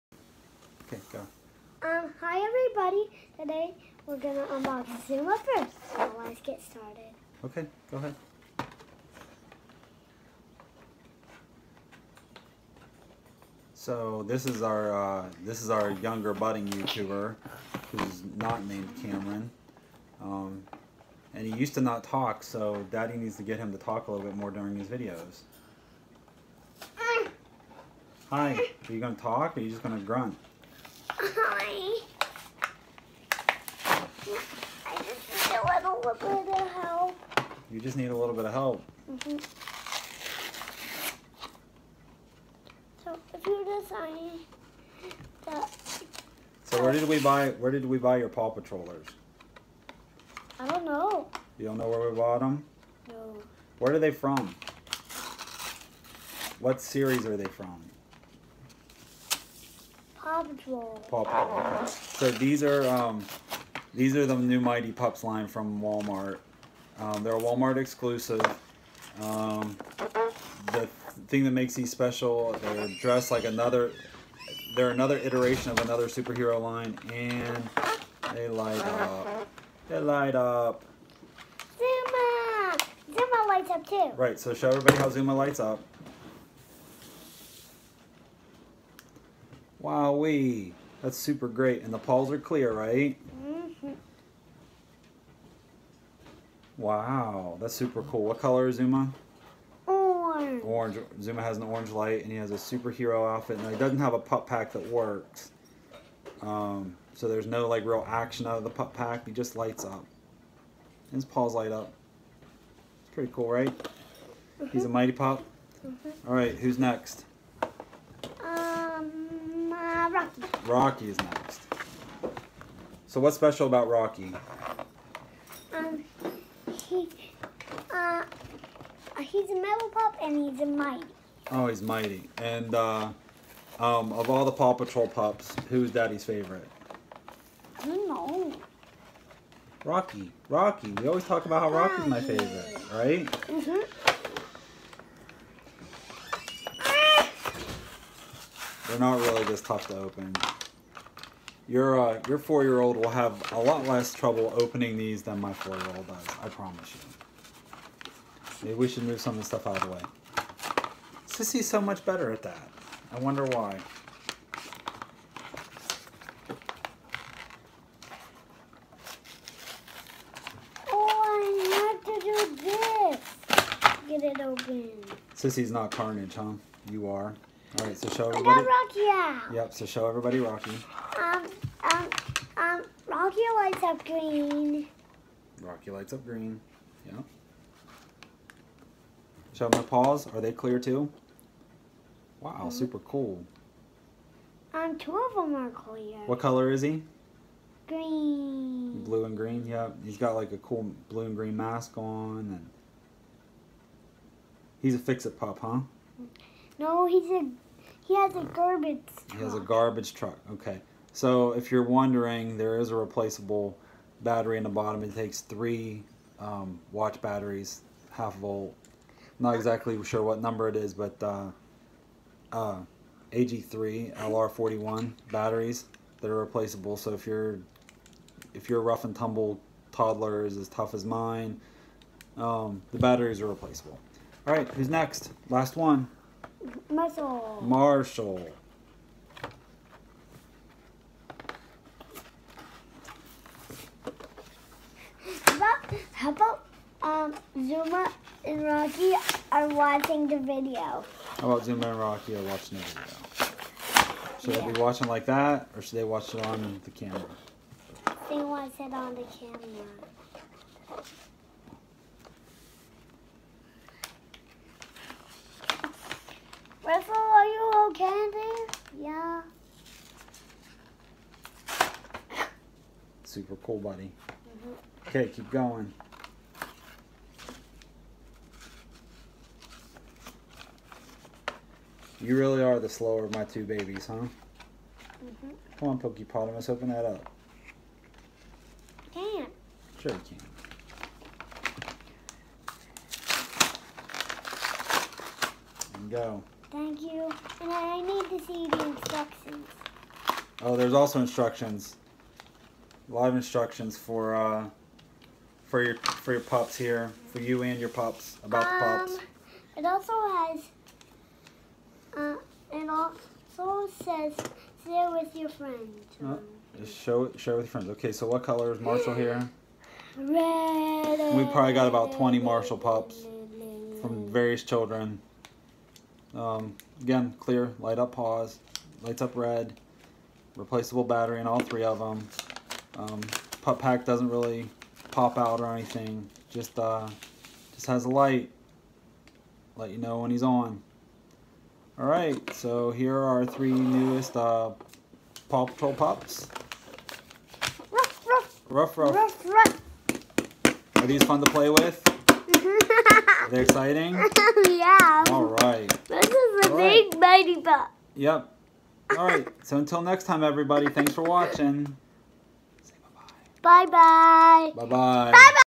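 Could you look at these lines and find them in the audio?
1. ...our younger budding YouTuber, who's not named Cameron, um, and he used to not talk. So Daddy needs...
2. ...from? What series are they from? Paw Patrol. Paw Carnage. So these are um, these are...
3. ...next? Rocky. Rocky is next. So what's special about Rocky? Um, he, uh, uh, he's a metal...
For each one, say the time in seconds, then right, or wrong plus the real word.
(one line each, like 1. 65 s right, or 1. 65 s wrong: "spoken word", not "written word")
1. 15 s right
2. 54 s wrong: "Patrol", not "Carnage"
3. 116 s right.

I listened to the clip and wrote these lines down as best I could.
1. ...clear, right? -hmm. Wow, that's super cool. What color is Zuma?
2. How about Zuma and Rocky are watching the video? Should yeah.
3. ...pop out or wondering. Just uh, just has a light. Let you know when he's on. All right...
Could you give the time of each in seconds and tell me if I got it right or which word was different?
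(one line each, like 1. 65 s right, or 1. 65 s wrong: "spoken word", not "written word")
1. 92 s right
2. 251 s right
3. 335 s wrong: "anything", not "wondering".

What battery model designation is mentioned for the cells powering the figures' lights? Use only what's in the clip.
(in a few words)
AG3 LR41.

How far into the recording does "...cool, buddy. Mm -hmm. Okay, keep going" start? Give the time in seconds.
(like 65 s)
273 s.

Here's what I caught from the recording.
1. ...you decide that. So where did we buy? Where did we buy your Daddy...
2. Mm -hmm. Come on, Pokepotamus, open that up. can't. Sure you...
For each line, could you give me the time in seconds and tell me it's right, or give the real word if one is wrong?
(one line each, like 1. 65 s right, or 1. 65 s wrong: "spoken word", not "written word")
1. 43 s wrong: "Paw", not "Daddy"
2. 284 s right.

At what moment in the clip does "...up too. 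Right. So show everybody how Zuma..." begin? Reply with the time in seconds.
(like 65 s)
83 s.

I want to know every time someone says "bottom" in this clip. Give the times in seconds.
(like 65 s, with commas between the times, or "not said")
214 s.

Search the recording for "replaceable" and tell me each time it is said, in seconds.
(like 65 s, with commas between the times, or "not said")
212 s, 226 s, 233 s, 330 s.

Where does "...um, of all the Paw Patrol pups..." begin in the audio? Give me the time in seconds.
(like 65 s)
133 s.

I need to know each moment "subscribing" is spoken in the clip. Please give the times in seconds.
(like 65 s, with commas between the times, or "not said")
not said.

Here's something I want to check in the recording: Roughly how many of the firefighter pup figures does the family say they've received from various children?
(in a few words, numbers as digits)
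20.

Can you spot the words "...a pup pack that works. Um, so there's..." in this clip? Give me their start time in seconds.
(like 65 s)
104 s.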